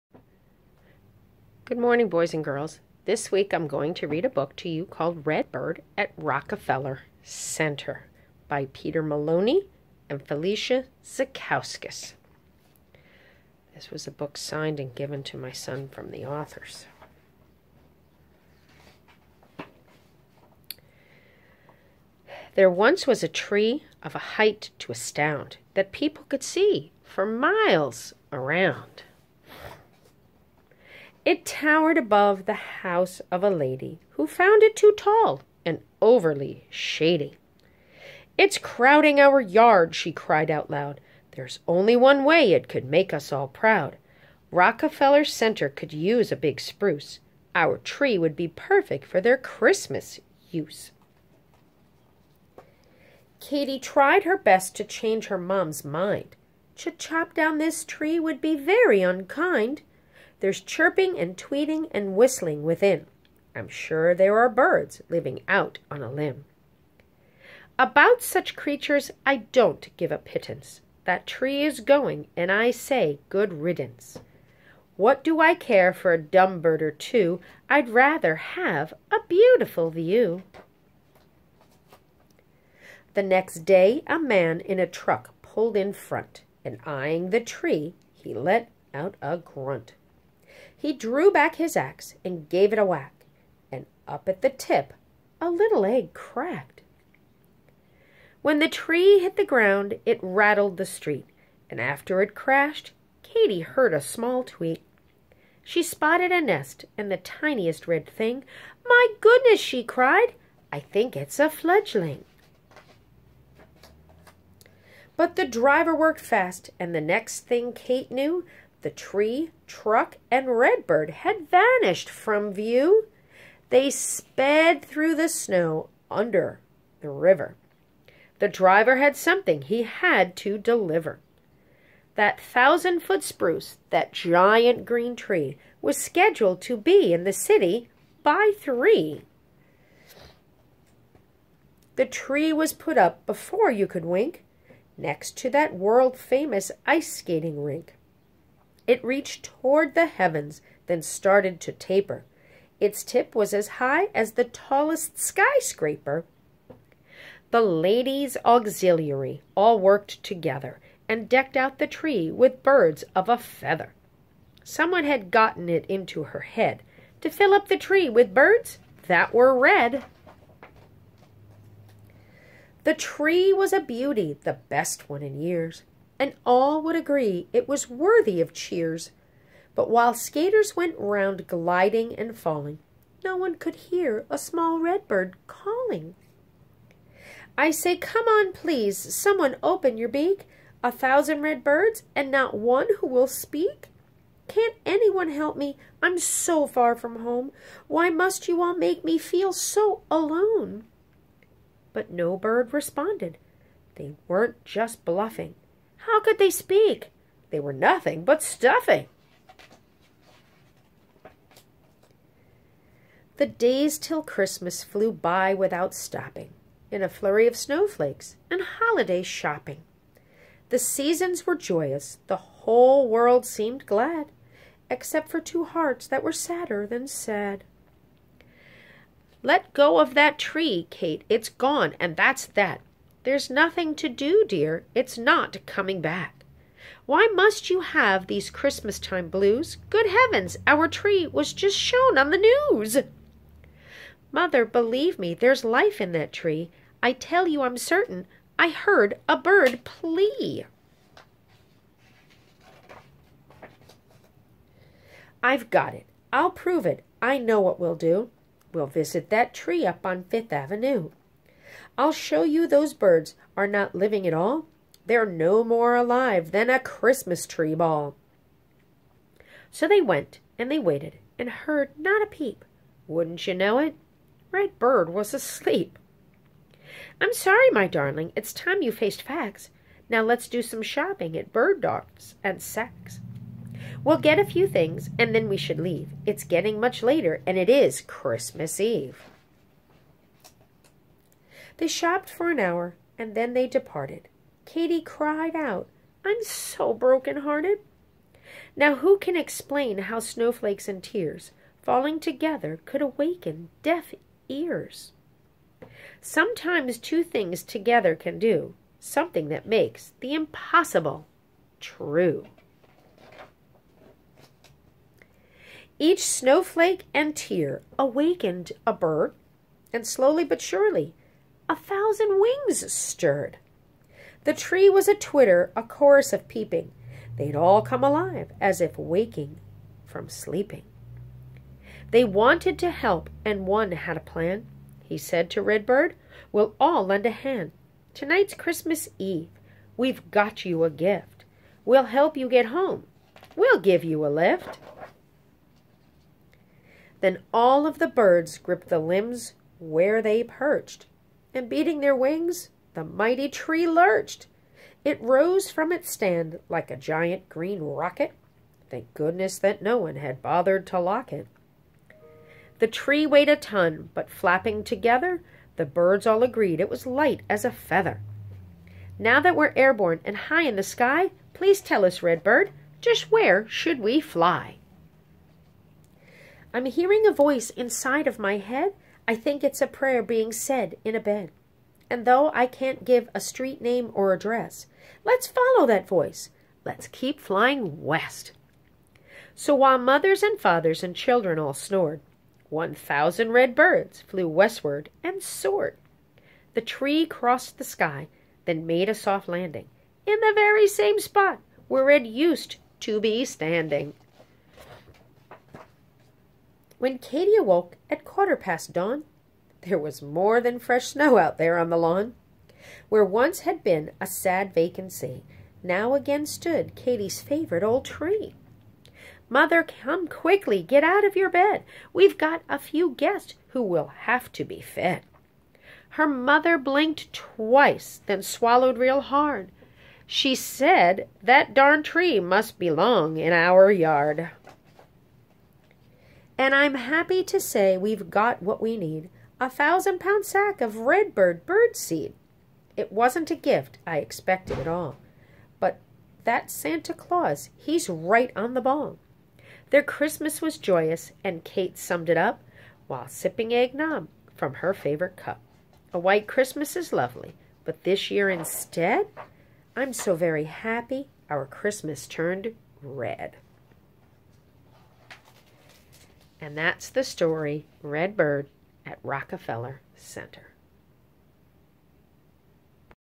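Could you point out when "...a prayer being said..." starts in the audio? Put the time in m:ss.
6:19.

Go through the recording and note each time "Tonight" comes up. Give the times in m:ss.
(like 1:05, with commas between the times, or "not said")
5:38.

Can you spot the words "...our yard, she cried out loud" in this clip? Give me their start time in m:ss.
0:39.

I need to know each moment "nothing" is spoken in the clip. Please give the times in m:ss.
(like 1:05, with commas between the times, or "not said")
3:27, 3:53.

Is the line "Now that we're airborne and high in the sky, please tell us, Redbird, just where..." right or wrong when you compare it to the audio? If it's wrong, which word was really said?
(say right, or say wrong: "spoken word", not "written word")
right.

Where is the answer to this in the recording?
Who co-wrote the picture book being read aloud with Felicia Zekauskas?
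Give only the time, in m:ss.
0:08.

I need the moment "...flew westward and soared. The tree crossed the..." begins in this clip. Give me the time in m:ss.
6:34.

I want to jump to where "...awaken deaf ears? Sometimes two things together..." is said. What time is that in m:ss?
5:03.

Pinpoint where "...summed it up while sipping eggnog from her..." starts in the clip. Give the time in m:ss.
7:31.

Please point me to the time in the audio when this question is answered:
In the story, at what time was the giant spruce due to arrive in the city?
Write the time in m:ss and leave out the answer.
2:18.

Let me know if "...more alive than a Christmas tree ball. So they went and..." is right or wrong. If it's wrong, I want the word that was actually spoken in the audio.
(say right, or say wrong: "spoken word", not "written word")
right.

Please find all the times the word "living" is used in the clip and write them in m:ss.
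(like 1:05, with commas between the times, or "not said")
1:05, 4:23.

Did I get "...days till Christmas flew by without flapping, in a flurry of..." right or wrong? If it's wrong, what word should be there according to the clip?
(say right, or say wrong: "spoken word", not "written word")
wrong: "stopping", not "flapping".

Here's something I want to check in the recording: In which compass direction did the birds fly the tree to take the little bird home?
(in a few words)
West.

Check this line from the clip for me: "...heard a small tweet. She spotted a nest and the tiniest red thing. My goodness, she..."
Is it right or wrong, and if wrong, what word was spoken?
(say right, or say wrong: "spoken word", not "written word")
right.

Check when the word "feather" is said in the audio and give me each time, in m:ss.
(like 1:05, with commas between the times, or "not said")
2:43, 6:07.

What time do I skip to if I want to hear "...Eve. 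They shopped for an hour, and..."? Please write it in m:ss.
4:48.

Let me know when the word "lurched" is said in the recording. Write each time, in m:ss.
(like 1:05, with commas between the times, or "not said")
5:53.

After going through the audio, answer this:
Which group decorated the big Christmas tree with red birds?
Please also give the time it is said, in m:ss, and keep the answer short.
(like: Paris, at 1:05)
The ladies' auxiliary, at 2:37.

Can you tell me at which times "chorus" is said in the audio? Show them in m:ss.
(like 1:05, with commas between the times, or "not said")
5:25.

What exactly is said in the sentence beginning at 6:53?
Where once had been a sad vacancy, now again stood Katy's favorite old tree.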